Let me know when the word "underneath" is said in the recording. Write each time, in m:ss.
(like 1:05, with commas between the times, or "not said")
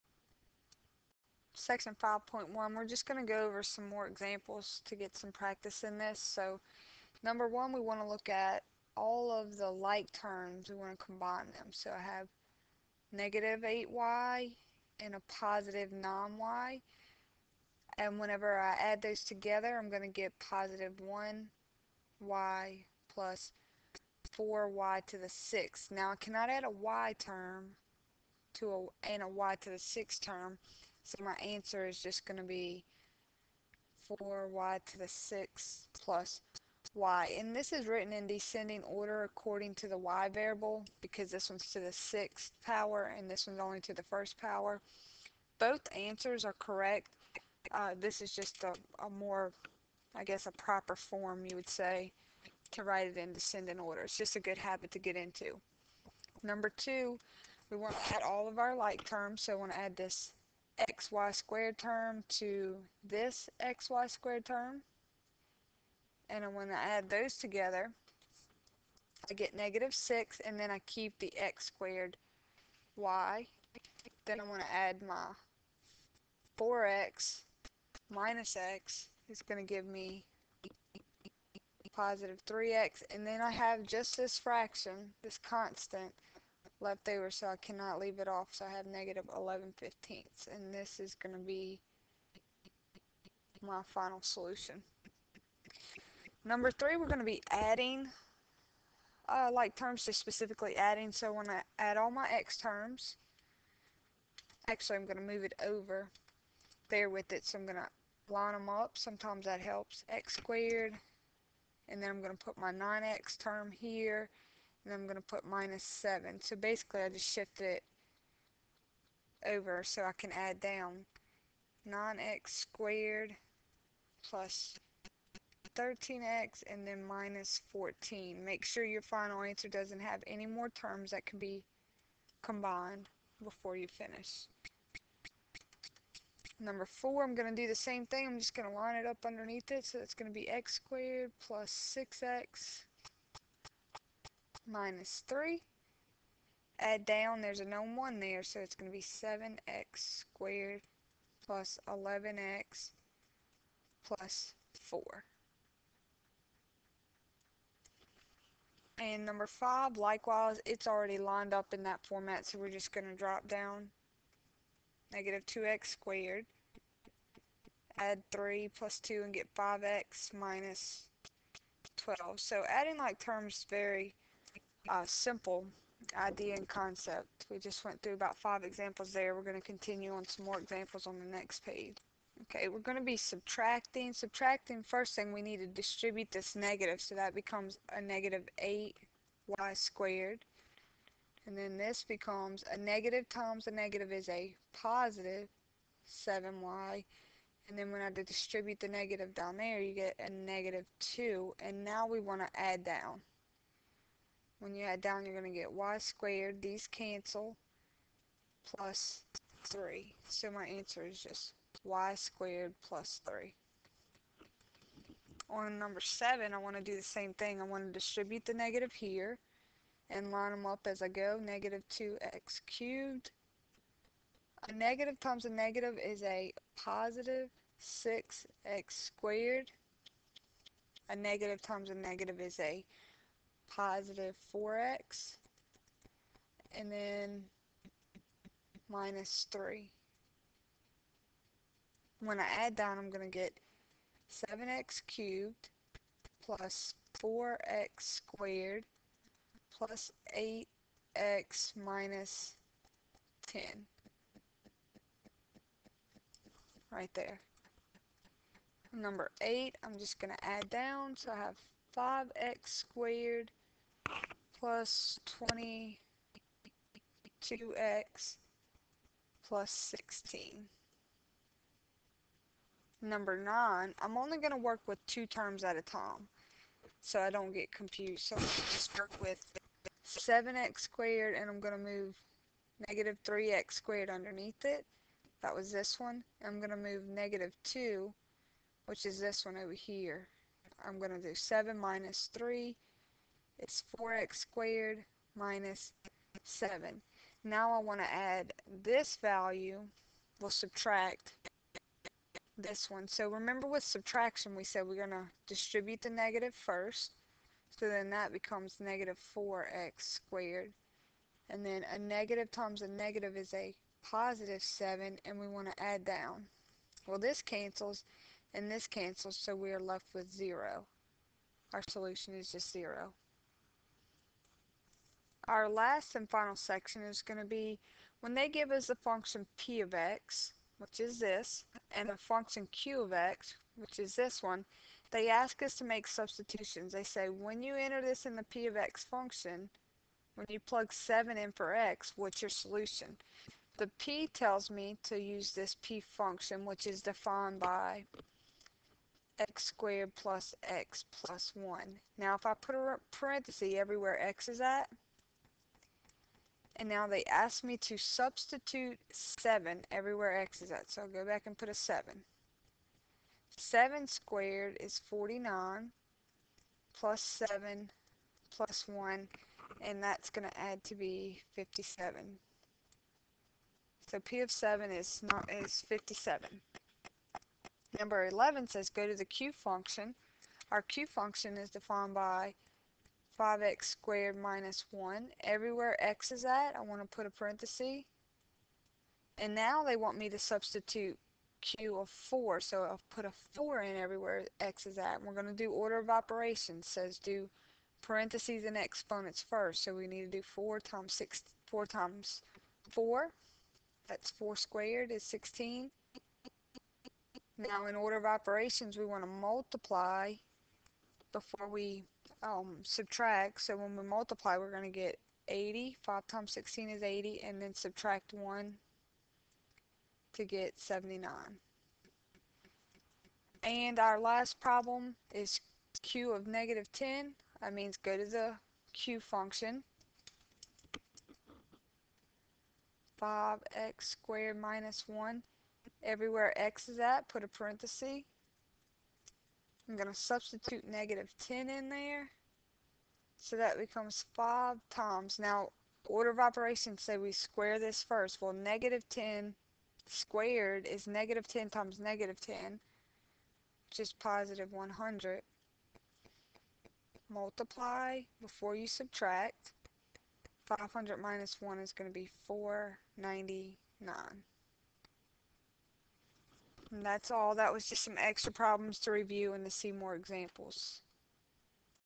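2:19, 4:44.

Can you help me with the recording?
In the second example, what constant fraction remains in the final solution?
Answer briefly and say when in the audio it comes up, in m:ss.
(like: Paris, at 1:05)
-11/15, at 1:28.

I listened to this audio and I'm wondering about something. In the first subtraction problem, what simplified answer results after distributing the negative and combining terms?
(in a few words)
y^2 + 3.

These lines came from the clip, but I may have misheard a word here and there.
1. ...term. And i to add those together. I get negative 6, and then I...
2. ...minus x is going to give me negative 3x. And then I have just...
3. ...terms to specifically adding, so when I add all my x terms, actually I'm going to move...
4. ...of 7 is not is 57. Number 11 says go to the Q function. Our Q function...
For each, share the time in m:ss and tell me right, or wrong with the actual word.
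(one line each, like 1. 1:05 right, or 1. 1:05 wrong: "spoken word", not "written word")
1. 1:04 right
2. 1:18 wrong: "positive", not "negative"
3. 1:39 right
4. 6:14 right.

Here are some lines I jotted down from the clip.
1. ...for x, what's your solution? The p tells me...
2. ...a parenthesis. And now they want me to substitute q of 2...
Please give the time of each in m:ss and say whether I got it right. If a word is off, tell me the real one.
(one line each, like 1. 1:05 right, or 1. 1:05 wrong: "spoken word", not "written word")
1. 5:41 right
2. 6:27 wrong: "4", not "2".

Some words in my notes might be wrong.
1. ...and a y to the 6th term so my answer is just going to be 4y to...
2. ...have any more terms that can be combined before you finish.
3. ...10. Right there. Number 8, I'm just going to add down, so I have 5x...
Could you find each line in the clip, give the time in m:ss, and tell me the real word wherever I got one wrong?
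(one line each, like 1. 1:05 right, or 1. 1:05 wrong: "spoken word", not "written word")
1. 0:29 right
2. 2:10 right
3. 4:13 right.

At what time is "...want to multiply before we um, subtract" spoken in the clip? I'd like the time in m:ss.
6:49.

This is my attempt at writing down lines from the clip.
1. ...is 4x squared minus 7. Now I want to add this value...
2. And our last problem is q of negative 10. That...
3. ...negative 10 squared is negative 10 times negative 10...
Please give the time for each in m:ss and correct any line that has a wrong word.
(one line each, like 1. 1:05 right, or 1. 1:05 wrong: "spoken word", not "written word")
1. 4:53 right
2. 7:03 right
3. 7:28 right.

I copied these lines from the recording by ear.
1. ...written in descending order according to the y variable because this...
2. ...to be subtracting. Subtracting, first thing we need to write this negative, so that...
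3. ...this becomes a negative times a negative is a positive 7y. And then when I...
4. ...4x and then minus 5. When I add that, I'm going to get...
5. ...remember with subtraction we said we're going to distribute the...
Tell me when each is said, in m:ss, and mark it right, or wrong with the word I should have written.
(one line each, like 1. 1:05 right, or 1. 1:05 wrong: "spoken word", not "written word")
1. 0:37 right
2. 3:02 wrong: "distribute", not "write"
3. 3:11 right
4. 3:54 wrong: "3", not "5"
5. 5:03 right.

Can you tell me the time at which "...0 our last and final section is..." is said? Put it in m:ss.
5:22.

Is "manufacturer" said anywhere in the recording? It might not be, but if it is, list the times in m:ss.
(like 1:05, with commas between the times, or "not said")
not said.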